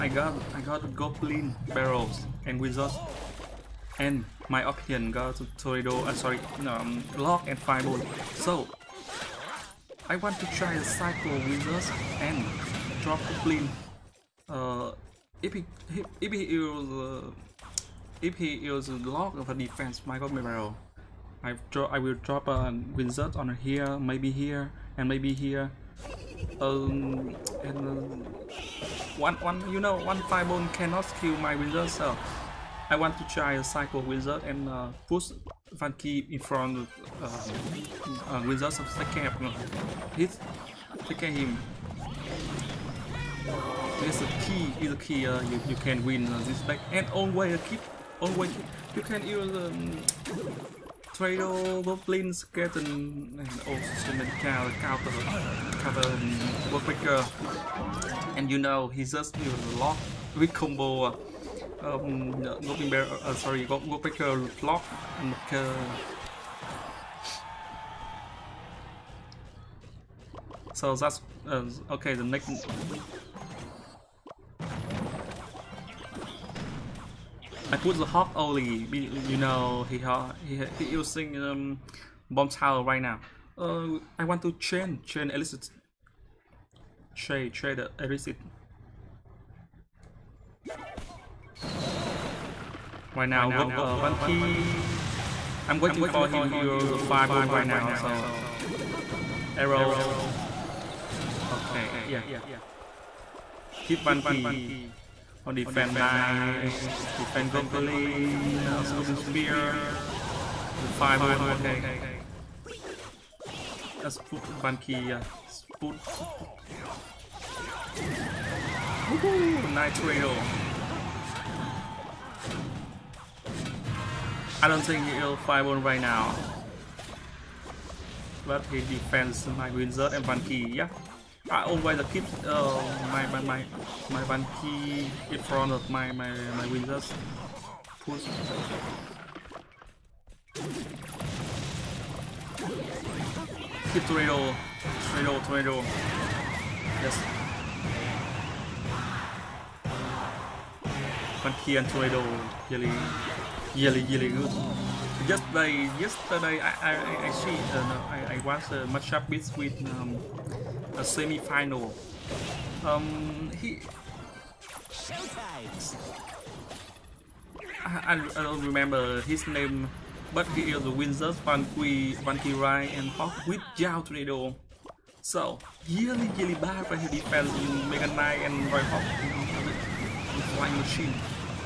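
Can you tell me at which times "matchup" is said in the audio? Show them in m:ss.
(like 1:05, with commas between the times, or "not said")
2:38.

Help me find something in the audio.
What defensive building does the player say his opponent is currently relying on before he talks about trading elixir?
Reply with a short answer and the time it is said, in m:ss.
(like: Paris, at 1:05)
Bomb tower, at 1:22.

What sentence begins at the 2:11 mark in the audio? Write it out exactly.
I always keep uh, um, my, my, my, my one key in front of my, my, my windows.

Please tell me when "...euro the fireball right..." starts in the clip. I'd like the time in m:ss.
1:36.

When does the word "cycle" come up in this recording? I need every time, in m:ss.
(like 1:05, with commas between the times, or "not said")
0:10, 0:33.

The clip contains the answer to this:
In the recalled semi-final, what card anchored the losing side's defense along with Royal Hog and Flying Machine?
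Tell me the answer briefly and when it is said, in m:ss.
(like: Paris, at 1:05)
Mega Knight, at 2:57.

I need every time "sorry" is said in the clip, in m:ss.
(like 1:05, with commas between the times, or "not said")
0:06, 1:03.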